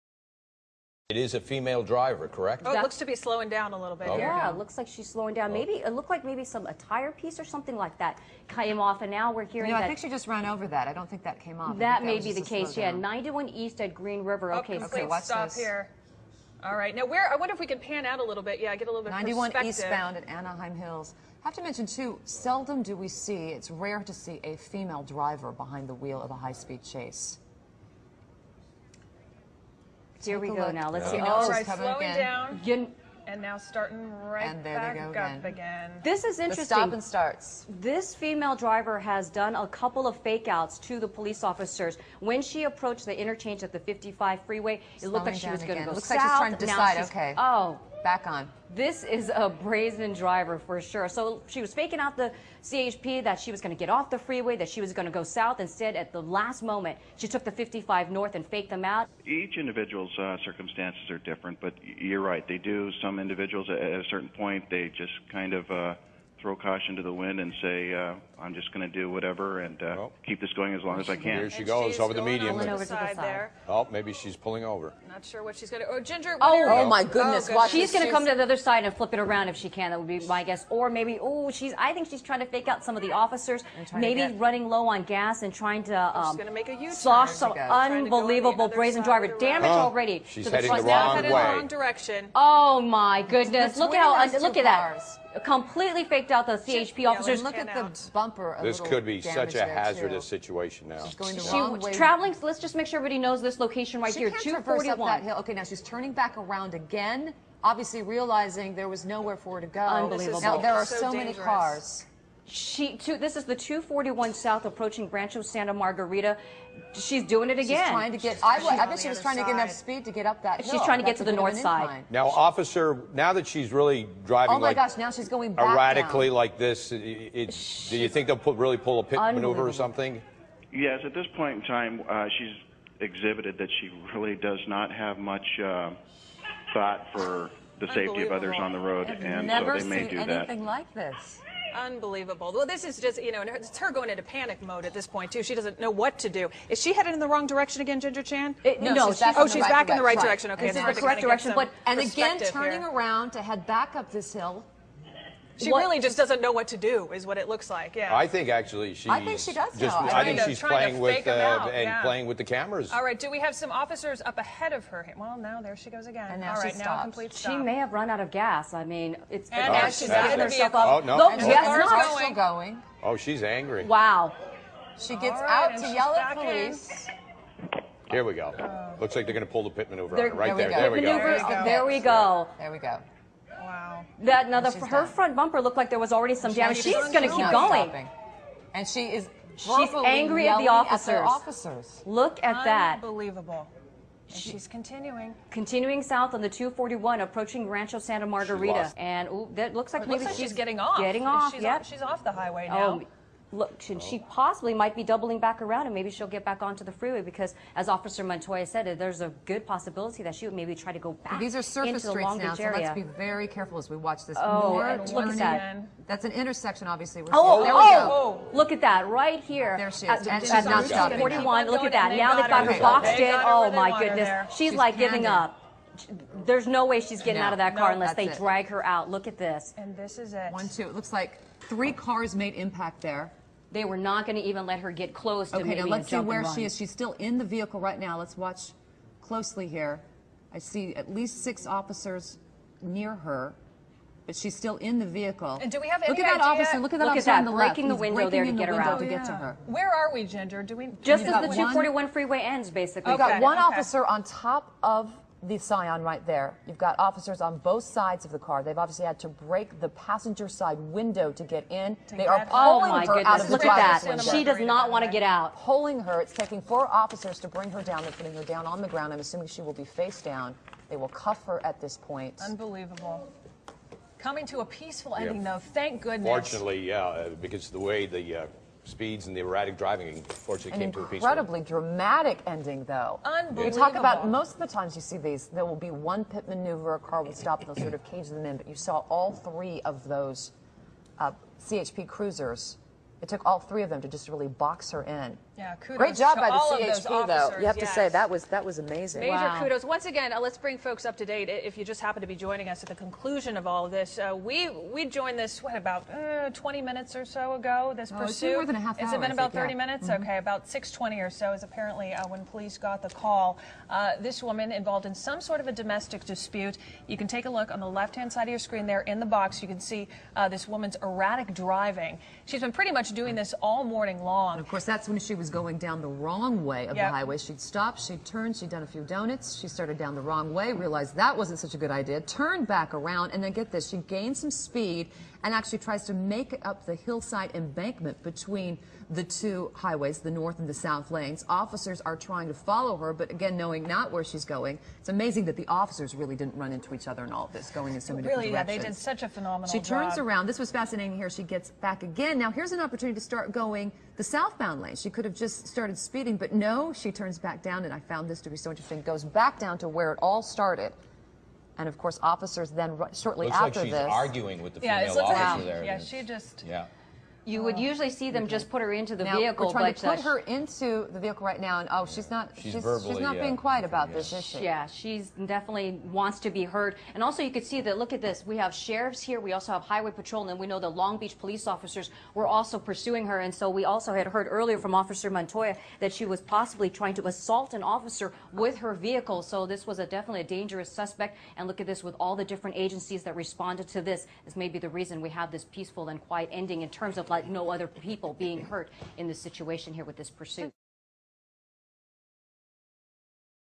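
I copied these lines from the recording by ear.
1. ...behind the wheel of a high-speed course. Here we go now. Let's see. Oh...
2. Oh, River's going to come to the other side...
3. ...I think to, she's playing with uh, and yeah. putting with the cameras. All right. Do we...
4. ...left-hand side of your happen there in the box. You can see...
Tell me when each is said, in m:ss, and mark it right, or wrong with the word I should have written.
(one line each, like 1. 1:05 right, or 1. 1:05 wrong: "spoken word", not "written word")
1. 0:25 wrong: "chase", not "course"
2. 1:17 wrong: "She", not "River"
3. 2:40 wrong: "playing", not "putting"
4. 5:17 wrong: "screen", not "happen".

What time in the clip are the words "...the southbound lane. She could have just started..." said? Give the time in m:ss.
5:54.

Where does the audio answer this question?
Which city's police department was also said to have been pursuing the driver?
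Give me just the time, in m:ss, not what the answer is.
6:20.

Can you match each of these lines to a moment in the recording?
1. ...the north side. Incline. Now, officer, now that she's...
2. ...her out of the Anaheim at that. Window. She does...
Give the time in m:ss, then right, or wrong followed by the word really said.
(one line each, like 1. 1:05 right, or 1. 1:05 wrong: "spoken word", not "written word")
1. 2:01 right
2. 4:23 wrong: "Look", not "Anaheim".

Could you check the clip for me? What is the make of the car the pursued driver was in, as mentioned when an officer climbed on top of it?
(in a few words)
Scion.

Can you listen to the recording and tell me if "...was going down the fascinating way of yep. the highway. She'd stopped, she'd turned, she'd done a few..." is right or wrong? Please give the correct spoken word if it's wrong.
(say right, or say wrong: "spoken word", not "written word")
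wrong: "wrong", not "fascinating".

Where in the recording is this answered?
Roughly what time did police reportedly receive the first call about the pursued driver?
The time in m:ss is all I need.
5:10.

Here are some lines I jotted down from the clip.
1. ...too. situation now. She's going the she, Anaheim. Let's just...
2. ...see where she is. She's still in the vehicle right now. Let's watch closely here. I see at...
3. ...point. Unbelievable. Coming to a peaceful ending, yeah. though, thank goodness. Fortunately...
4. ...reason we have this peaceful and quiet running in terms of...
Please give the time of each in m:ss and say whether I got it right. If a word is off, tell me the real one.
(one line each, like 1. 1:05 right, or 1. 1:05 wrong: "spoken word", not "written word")
1. 1:40 wrong: "Traveling", not "Anaheim"
2. 3:56 right
3. 4:31 right
4. 6:34 wrong: "ending", not "running".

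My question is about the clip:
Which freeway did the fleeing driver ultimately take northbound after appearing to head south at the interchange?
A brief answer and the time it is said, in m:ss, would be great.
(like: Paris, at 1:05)
55, at 0:57.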